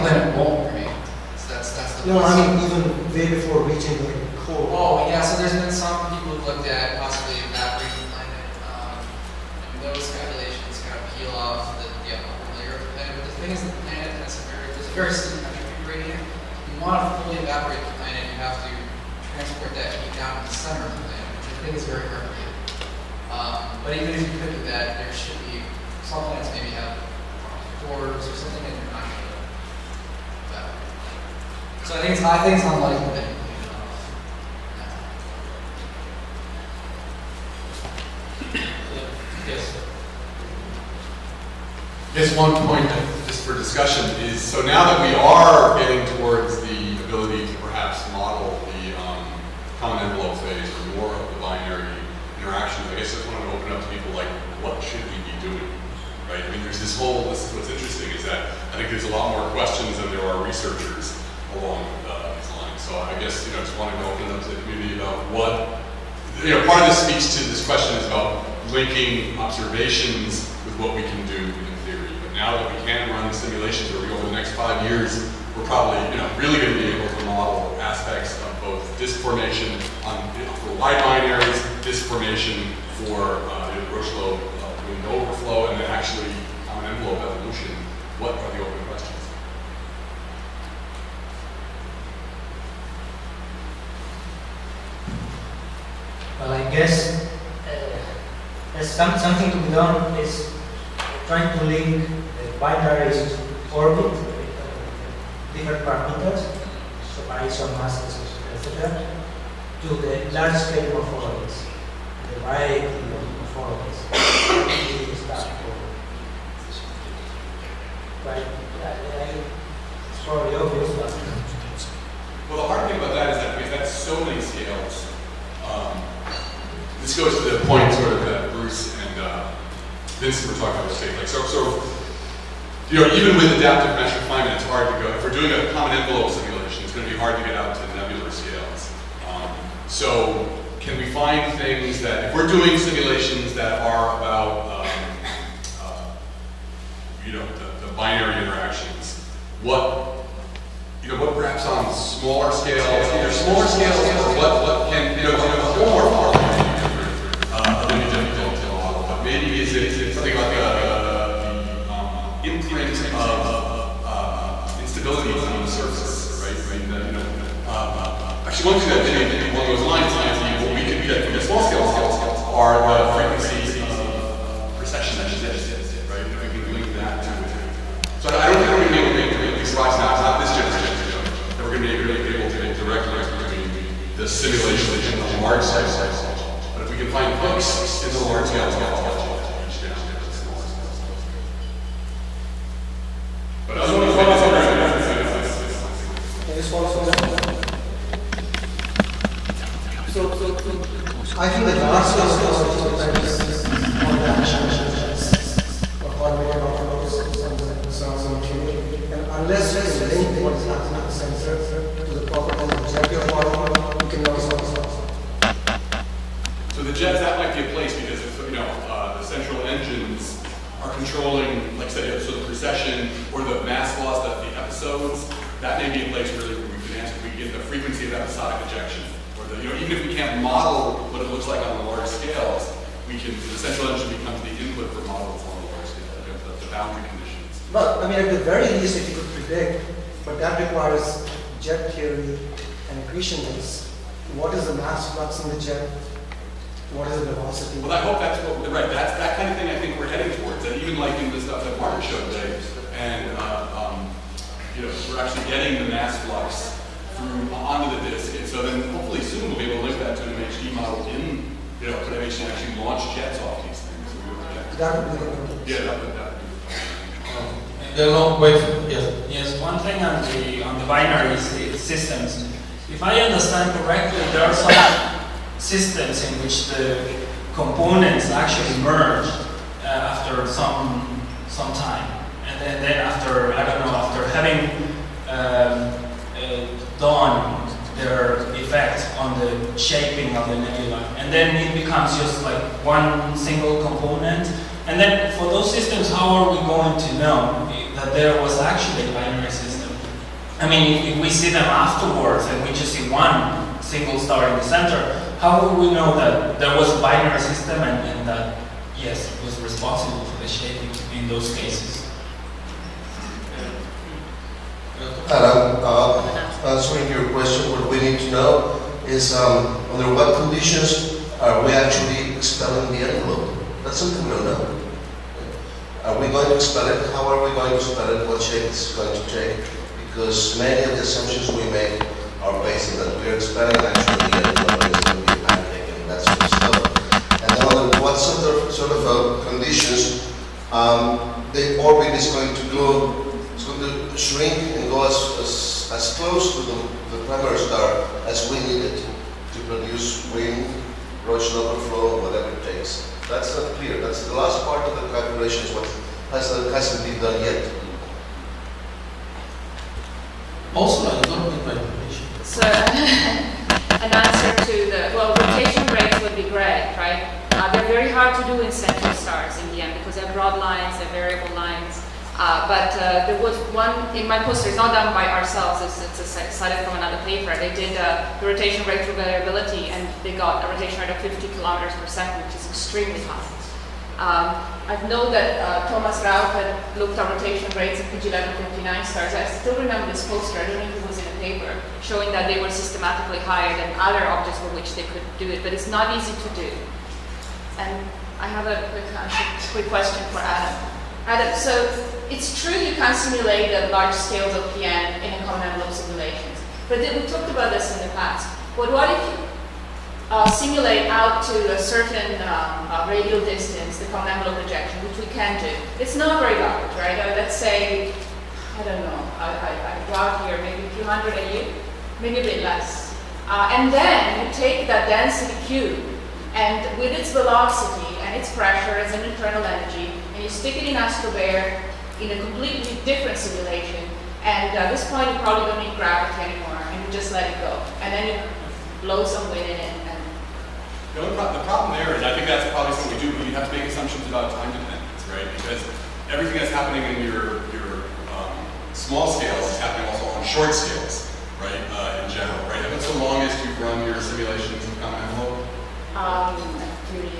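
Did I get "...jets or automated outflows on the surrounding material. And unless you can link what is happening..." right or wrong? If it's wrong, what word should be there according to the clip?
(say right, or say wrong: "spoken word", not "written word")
right.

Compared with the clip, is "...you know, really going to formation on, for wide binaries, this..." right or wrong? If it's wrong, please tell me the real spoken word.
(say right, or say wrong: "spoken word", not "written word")
right.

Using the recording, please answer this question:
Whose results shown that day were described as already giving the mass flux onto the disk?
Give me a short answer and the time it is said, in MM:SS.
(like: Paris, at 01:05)
Martin, at 04:11.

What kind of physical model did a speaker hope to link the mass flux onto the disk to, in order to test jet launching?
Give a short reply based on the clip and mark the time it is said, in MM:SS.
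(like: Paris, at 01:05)
MHD model, at 04:20.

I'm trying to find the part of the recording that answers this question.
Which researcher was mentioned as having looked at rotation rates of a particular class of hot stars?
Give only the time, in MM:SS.
06:25.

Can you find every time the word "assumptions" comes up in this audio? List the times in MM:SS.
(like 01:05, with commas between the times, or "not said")
05:31, 07:23.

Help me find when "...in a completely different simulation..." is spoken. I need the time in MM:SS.
07:12.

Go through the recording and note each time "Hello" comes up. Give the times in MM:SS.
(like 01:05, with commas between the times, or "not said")
05:15.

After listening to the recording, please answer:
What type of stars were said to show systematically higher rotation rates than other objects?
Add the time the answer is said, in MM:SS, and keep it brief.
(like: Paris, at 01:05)
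PG1159 stars, at 06:28.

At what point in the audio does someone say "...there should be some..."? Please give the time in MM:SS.
00:24.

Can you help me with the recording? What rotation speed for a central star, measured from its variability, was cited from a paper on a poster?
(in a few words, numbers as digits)
50 km/s.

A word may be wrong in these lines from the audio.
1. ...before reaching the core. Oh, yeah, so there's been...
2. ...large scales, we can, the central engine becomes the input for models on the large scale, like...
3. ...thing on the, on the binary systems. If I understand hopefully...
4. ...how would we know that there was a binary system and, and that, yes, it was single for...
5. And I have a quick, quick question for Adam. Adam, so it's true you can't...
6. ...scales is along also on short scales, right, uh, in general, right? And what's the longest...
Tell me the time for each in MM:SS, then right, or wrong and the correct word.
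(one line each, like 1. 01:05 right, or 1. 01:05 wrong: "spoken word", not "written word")
1. 00:03 right
2. 03:51 right
3. 04:29 wrong: "correctly", not "hopefully"
4. 05:05 wrong: "responsible", not "single"
5. 06:37 right
6. 07:29 wrong: "happening", not "along".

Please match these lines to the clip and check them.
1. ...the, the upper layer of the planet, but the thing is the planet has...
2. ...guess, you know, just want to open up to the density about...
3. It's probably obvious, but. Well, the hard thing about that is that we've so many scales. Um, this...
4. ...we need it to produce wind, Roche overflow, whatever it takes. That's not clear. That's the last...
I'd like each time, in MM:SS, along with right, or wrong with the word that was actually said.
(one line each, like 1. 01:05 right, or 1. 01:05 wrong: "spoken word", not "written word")
1. 00:11 right
2. 01:03 wrong: "community", not "density"
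3. 02:00 right
4. 05:48 right.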